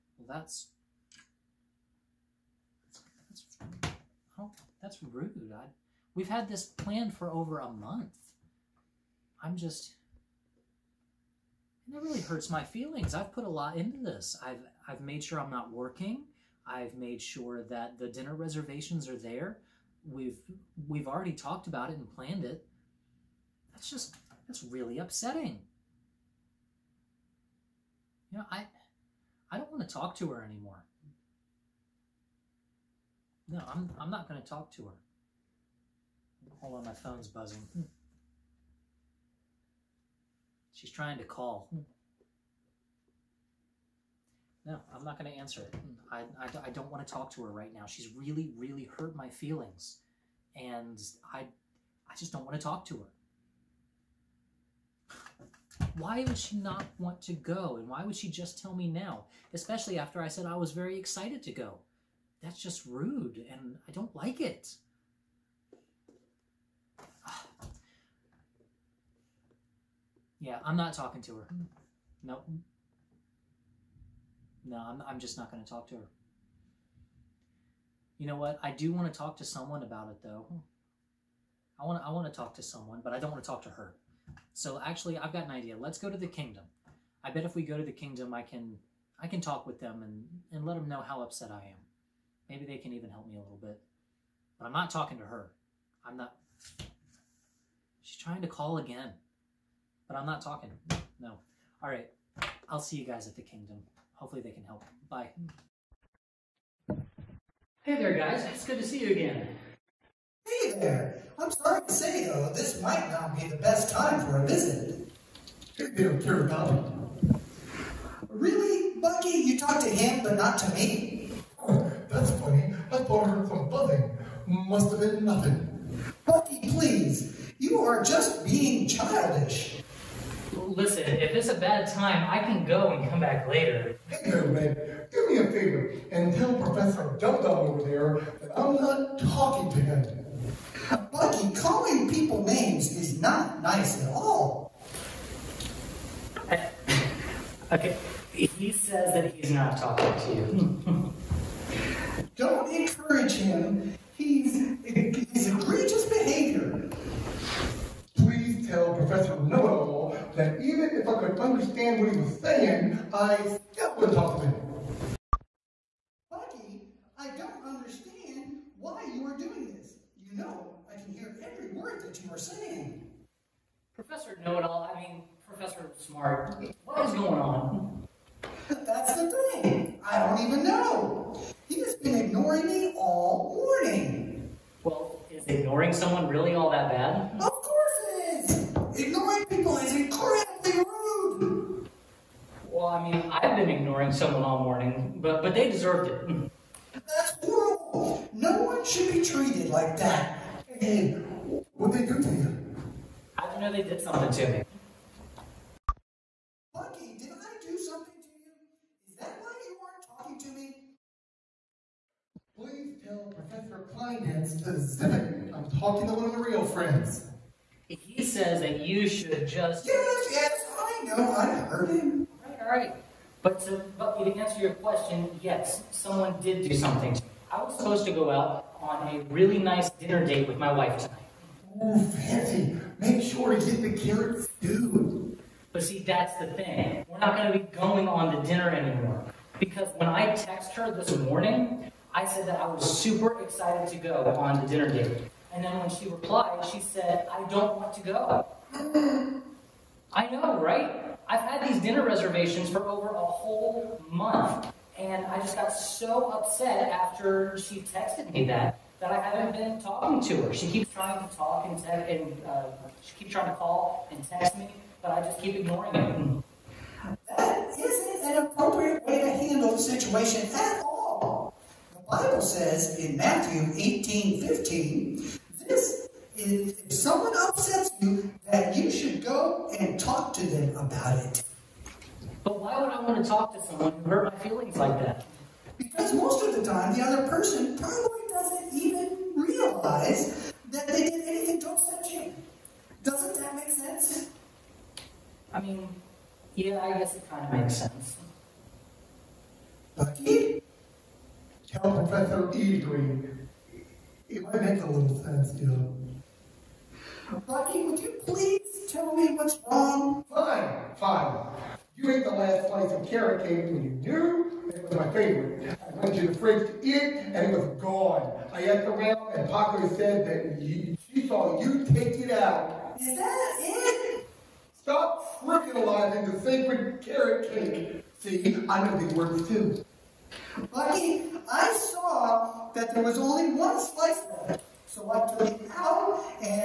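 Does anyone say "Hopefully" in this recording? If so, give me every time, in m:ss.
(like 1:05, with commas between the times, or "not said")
1:44.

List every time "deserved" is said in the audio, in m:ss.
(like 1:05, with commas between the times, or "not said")
3:15.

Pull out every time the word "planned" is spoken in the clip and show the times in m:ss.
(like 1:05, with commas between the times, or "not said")
0:06, 0:22.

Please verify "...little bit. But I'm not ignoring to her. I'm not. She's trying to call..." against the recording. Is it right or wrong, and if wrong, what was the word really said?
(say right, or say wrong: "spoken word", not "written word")
wrong: "talking", not "ignoring".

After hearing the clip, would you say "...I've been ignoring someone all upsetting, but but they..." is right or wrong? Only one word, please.
wrong.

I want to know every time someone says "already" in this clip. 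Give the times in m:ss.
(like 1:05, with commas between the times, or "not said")
0:21.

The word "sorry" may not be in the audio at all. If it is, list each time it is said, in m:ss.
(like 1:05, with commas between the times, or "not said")
1:51.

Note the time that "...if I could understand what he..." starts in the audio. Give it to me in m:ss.
2:41.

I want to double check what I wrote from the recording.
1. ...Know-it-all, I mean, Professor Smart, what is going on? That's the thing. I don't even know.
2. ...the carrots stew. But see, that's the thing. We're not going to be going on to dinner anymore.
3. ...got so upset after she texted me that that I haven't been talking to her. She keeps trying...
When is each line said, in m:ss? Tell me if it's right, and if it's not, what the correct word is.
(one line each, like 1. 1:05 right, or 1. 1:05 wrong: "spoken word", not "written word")
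1. 2:54 right
2. 3:53 right
3. 4:15 right.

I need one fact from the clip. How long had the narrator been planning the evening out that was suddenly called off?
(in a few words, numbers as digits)
over a month.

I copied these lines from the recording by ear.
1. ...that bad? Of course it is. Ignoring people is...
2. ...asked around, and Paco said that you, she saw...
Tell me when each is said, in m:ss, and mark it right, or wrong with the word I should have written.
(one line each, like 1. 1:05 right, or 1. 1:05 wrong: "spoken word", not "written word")
1. 3:06 right
2. 5:18 right.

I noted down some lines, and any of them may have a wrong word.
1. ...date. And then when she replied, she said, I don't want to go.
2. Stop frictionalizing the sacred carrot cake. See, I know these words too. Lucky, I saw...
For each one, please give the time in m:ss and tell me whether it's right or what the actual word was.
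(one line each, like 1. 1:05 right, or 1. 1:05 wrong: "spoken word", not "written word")
1. 4:04 right
2. 5:24 right.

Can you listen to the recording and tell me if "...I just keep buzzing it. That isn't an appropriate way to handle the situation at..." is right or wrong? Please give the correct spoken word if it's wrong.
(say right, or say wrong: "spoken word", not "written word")
wrong: "ignoring", not "buzzing".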